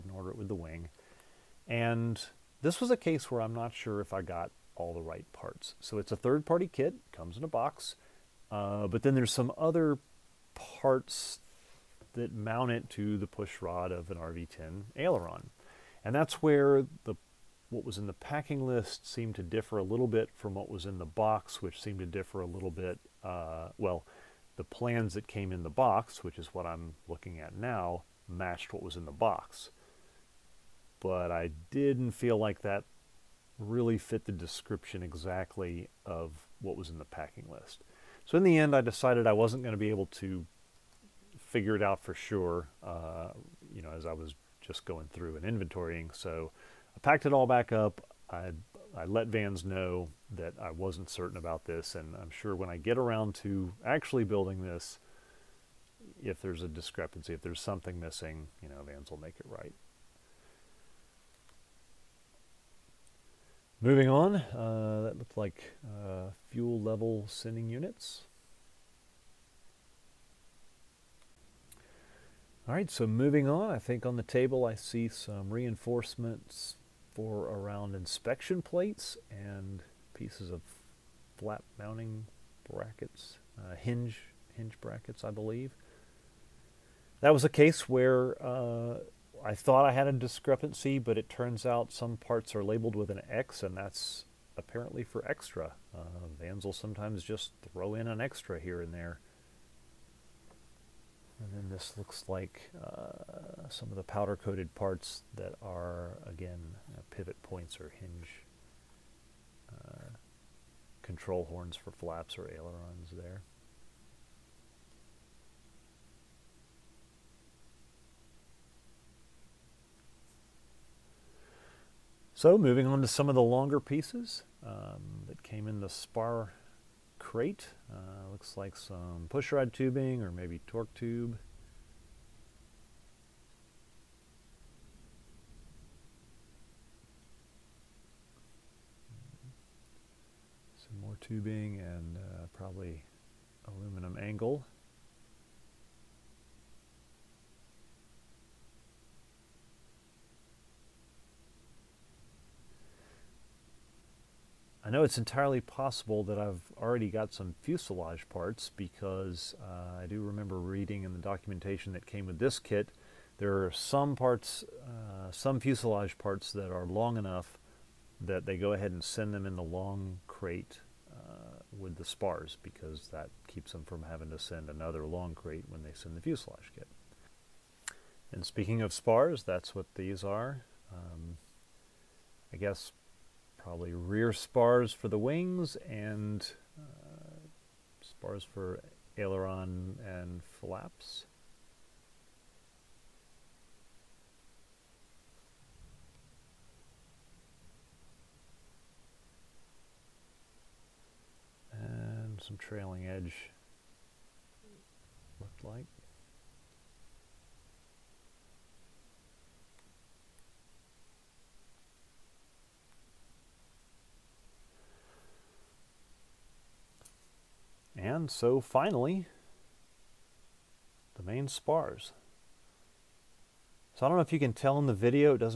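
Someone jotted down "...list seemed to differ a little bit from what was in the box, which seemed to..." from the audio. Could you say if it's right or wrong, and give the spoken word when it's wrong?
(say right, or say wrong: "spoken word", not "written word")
right.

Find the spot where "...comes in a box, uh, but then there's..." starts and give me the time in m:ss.
0:07.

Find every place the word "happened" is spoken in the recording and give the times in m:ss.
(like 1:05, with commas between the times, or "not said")
not said.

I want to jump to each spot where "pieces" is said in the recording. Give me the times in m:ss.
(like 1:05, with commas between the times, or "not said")
1:20, 2:03.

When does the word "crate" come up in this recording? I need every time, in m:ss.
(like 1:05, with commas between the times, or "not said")
2:07, 2:50, 2:55.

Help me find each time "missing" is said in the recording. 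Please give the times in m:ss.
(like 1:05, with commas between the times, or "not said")
0:57.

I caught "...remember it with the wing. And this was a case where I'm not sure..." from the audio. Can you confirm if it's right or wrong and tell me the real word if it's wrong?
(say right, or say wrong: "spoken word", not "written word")
wrong: "order", not "remember".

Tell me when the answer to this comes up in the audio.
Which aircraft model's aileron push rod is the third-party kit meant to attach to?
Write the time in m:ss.
0:14.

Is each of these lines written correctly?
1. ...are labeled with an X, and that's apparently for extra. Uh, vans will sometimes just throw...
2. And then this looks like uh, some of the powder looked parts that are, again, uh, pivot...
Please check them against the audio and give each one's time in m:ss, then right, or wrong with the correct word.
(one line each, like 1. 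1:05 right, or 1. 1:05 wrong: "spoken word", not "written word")
1. 1:32 right
2. 1:41 wrong: "coated", not "looked".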